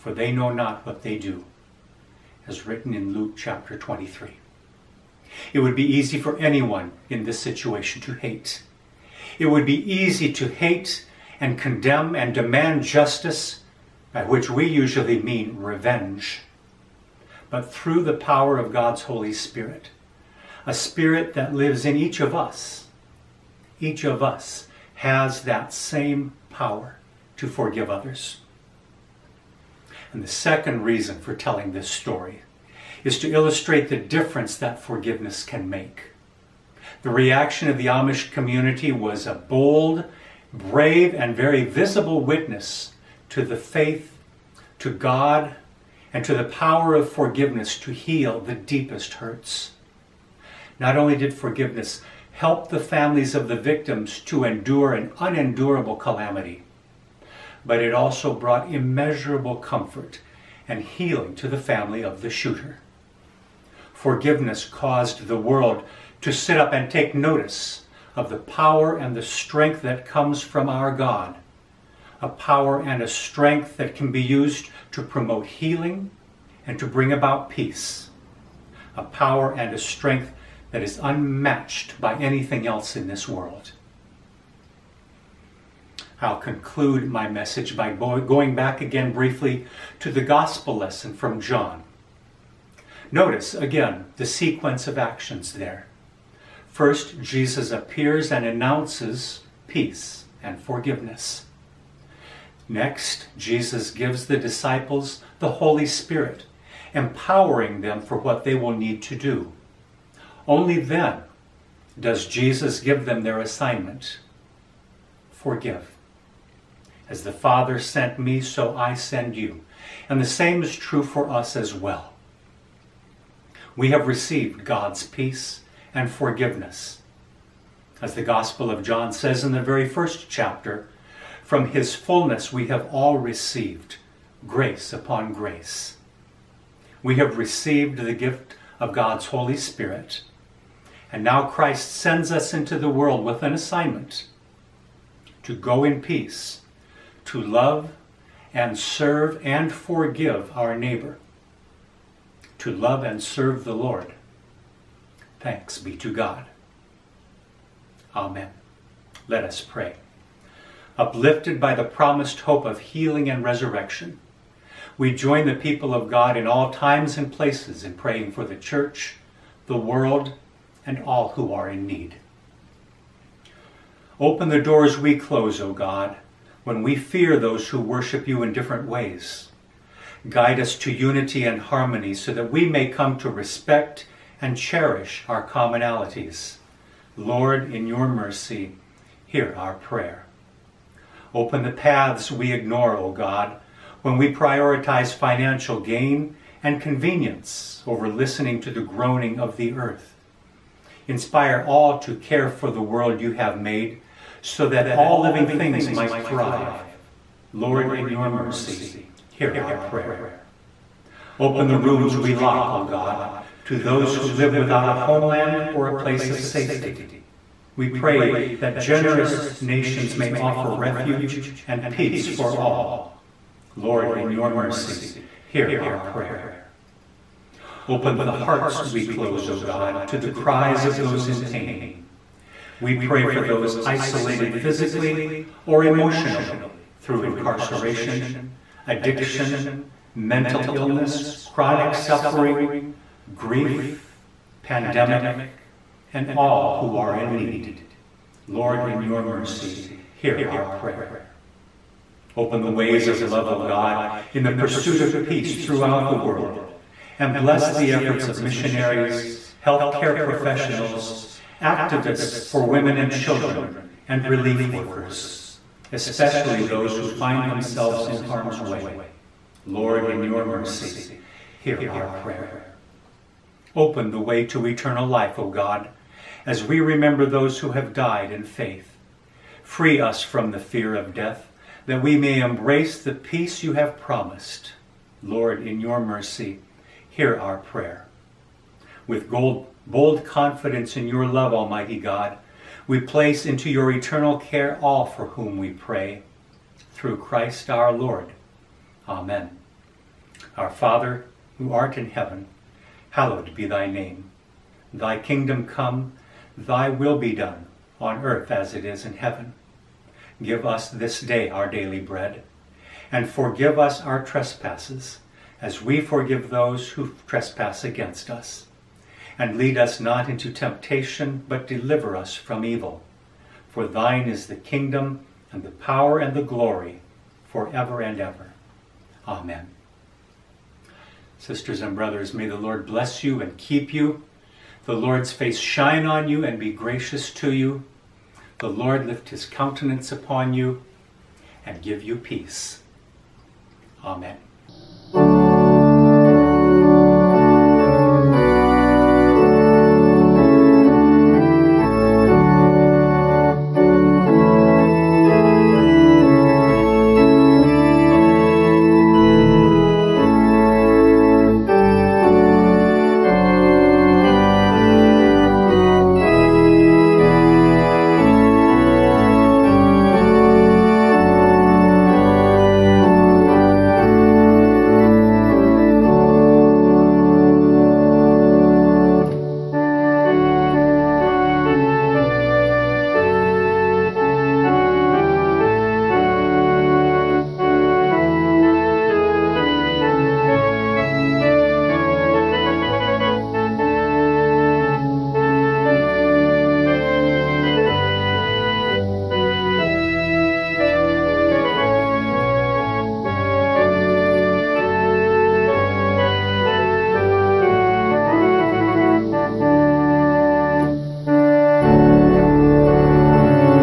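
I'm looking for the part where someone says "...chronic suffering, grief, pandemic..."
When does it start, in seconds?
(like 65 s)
241 s.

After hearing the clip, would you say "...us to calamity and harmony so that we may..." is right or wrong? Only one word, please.
wrong.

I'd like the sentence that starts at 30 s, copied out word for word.
And the second reason for telling this story is to illustrate the difference that forgiveness can make.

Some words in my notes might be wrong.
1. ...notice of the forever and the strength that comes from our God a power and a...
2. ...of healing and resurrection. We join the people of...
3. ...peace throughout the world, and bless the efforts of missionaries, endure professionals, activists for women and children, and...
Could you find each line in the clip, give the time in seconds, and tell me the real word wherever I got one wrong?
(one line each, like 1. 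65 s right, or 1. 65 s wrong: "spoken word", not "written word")
1. 67 s wrong: "power", not "forever"
2. 162 s right
3. 255 s wrong: "healthcare", not "endure".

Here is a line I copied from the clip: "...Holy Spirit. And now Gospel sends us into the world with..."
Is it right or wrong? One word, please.
wrong.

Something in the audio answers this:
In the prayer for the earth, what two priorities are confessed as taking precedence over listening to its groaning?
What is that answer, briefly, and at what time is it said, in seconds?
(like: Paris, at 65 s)
Financial gain and convenience, at 195 s.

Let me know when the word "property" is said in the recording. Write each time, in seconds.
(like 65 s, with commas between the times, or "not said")
not said.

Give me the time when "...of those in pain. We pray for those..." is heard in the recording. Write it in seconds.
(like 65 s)
230 s.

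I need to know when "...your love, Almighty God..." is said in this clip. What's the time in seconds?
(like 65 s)
291 s.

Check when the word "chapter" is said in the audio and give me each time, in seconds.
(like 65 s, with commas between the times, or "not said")
3 s, 130 s.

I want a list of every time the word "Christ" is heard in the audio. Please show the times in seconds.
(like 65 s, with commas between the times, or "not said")
141 s, 297 s.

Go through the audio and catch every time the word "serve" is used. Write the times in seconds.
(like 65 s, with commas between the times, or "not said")
148 s, 153 s.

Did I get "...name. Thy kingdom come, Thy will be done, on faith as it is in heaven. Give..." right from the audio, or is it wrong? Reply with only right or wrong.
wrong.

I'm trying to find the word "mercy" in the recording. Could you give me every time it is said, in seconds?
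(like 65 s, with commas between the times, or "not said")
188 s, 208 s, 224 s, 249 s, 270 s, 285 s.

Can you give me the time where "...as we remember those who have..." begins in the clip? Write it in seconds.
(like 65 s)
276 s.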